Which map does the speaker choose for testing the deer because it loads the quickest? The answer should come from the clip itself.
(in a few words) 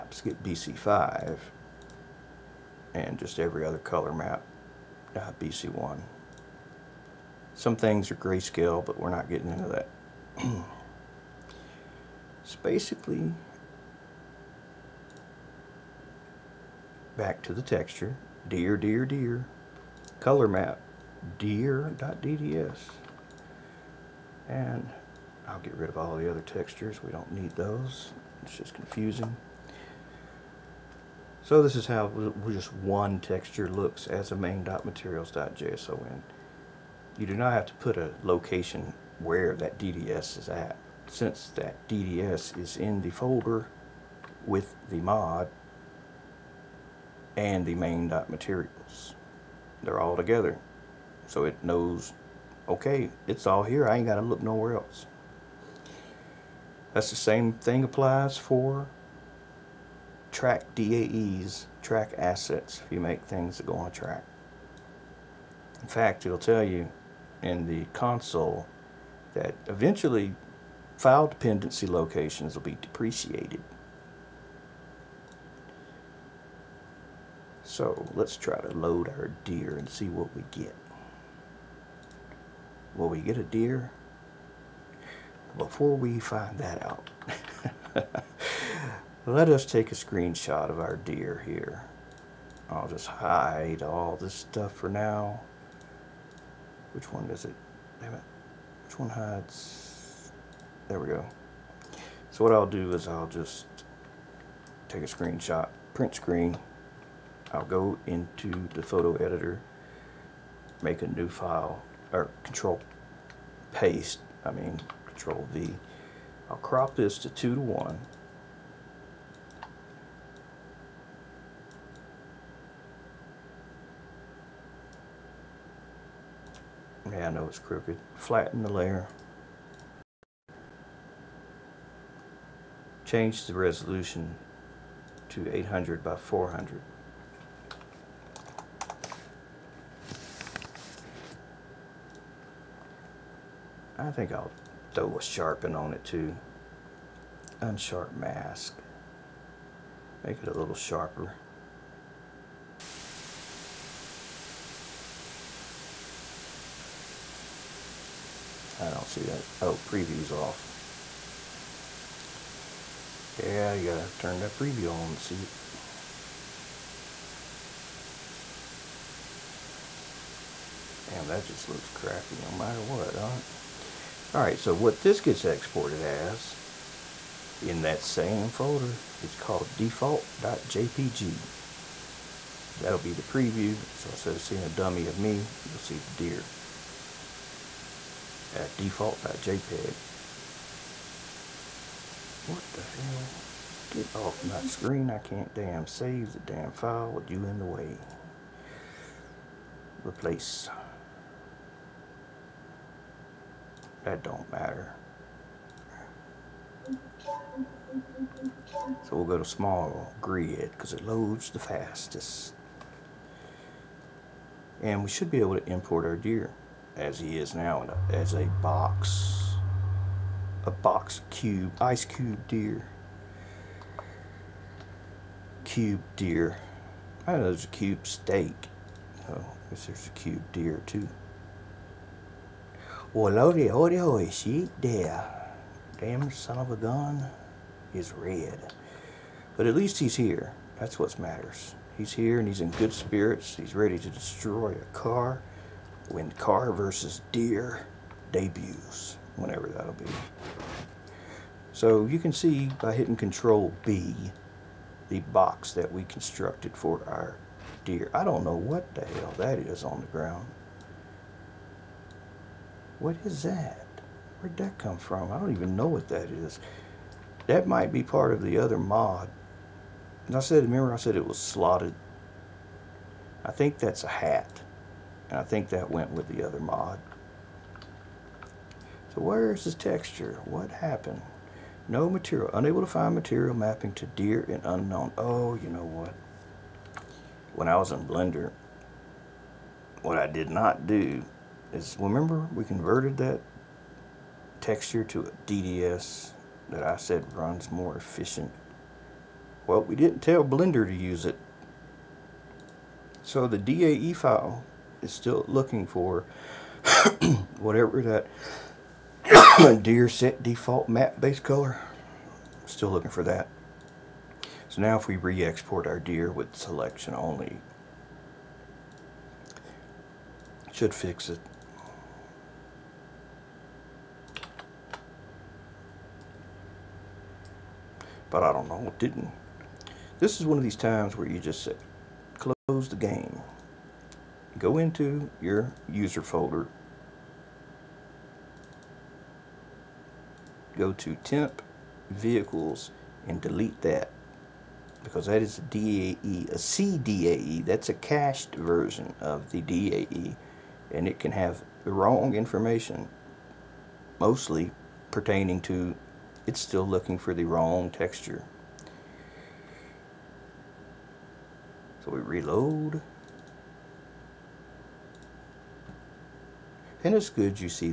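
Small grid.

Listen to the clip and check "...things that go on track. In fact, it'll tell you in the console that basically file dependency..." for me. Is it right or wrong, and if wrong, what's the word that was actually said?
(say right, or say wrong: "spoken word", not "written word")
wrong: "eventually", not "basically".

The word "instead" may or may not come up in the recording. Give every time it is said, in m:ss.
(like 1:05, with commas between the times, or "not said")
3:04.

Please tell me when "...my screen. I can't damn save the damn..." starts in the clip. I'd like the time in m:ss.
3:14.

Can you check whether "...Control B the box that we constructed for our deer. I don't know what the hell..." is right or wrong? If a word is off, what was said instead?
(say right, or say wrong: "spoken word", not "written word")
right.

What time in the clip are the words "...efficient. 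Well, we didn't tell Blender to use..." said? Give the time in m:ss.
4:57.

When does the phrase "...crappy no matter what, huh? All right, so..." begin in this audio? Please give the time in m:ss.
2:51.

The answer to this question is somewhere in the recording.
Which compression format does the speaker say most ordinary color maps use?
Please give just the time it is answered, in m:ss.
0:05.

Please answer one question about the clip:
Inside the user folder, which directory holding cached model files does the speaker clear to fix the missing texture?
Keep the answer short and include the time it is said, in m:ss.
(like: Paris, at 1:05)
temp vehicles, at 5:41.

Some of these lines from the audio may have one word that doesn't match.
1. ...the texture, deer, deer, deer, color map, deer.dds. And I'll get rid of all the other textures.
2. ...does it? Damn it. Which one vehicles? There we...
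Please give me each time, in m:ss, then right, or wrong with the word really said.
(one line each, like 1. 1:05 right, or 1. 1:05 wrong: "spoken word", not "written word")
1. 0:17 right
2. 1:37 wrong: "hides", not "vehicles".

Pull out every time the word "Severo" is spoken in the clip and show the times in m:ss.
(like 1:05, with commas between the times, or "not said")
not said.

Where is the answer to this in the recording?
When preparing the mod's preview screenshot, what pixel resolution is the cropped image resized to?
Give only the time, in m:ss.
2:15.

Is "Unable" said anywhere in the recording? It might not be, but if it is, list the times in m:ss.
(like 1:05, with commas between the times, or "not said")
4:42.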